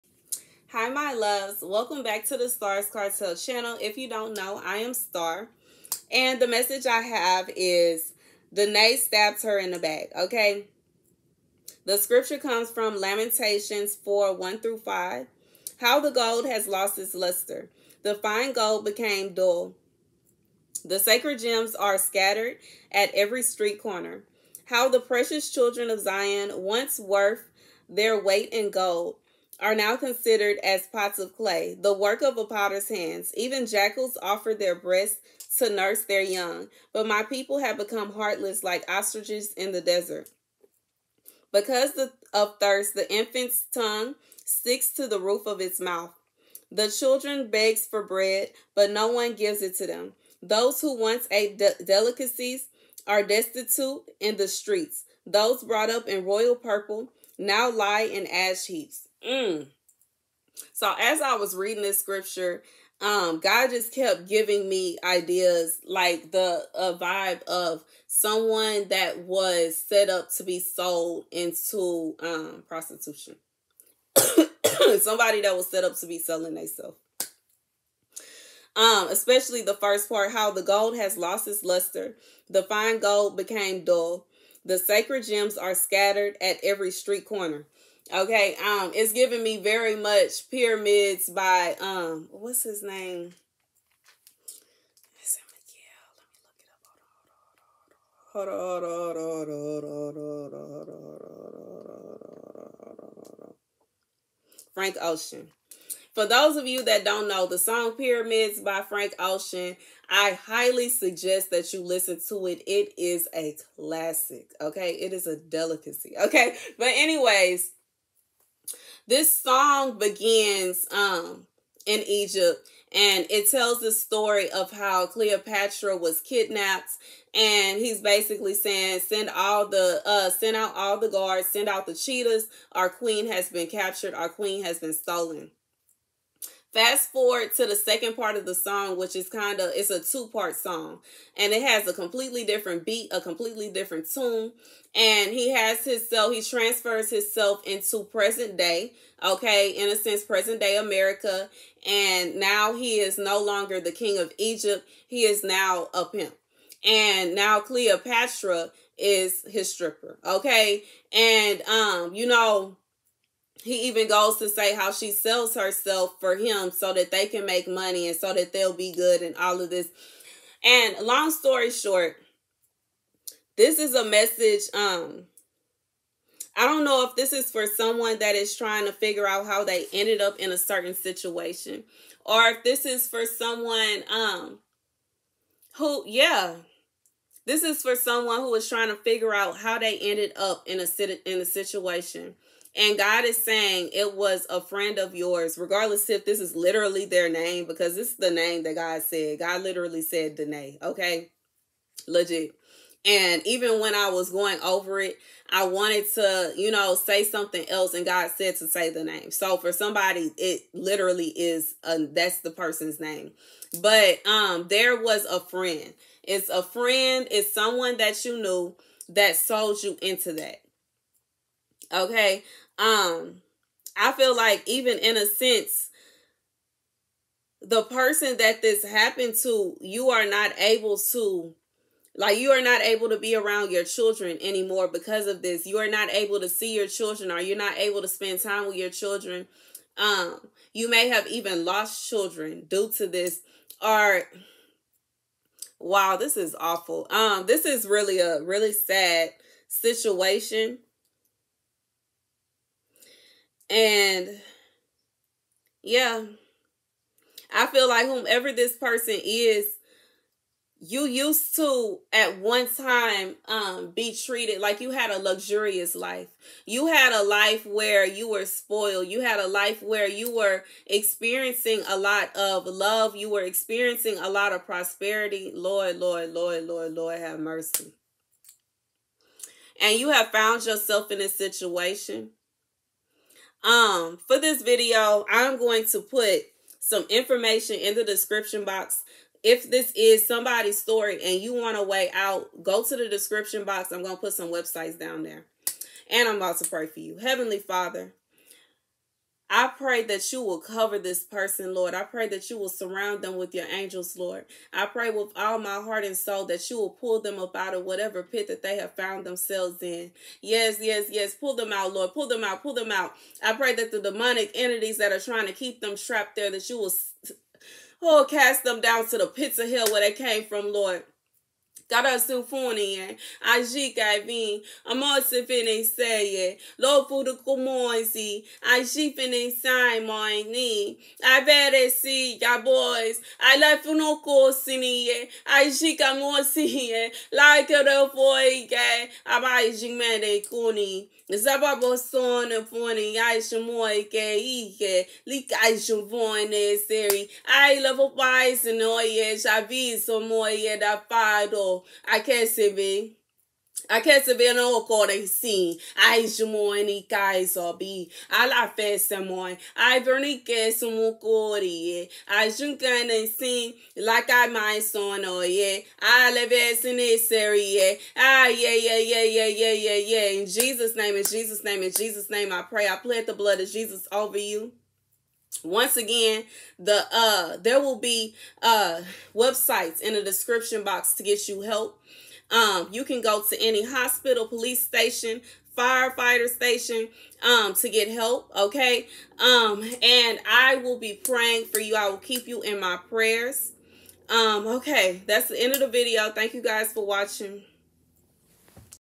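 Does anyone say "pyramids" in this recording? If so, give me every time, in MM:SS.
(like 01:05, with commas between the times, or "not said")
01:30, 01:47.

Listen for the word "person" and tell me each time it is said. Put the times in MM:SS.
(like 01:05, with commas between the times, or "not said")
03:32, 03:47, 04:18, 05:01.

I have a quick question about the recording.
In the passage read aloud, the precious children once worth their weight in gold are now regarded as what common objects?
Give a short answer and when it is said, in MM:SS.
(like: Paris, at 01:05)
pots of clay, at 00:30.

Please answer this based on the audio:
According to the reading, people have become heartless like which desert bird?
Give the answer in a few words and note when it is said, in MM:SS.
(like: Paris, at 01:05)
ostriches, at 00:38.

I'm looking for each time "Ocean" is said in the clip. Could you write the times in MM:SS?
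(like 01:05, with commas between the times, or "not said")
01:45, 01:49.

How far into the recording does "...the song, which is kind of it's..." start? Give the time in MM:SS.
02:18.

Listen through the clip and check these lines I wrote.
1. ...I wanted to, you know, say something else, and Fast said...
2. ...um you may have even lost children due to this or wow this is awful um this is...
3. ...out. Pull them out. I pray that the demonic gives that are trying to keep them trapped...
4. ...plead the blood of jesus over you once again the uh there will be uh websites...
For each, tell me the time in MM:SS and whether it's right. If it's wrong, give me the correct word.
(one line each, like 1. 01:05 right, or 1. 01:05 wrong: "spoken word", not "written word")
1. 03:25 wrong: "God", not "Fast"
2. 03:59 right
3. 05:12 wrong: "entities", not "gives"
4. 06:13 right.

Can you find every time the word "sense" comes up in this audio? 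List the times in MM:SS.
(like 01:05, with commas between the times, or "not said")
02:29, 03:45.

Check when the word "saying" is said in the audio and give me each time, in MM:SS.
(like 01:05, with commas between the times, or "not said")
02:08, 03:13.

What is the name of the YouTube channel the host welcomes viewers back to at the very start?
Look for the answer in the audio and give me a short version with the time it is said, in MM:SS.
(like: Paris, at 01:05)
Stars Cartel, at 00:02.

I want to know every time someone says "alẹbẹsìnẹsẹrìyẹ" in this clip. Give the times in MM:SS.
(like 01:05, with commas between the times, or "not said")
06:06.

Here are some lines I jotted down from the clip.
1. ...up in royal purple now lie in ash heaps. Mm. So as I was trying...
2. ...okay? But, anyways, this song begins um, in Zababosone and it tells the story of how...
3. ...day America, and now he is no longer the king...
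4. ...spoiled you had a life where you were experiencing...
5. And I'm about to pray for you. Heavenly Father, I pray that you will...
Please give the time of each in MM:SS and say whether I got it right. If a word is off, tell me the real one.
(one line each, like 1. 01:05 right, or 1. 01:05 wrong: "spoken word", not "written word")
1. 00:55 wrong: "reading", not "trying"
2. 01:56 wrong: "Egypt", not "Zababosone"
3. 02:30 right
4. 04:28 right
5. 04:56 right.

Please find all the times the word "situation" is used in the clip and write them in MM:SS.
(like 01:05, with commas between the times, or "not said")
03:00, 03:11, 04:09, 04:41.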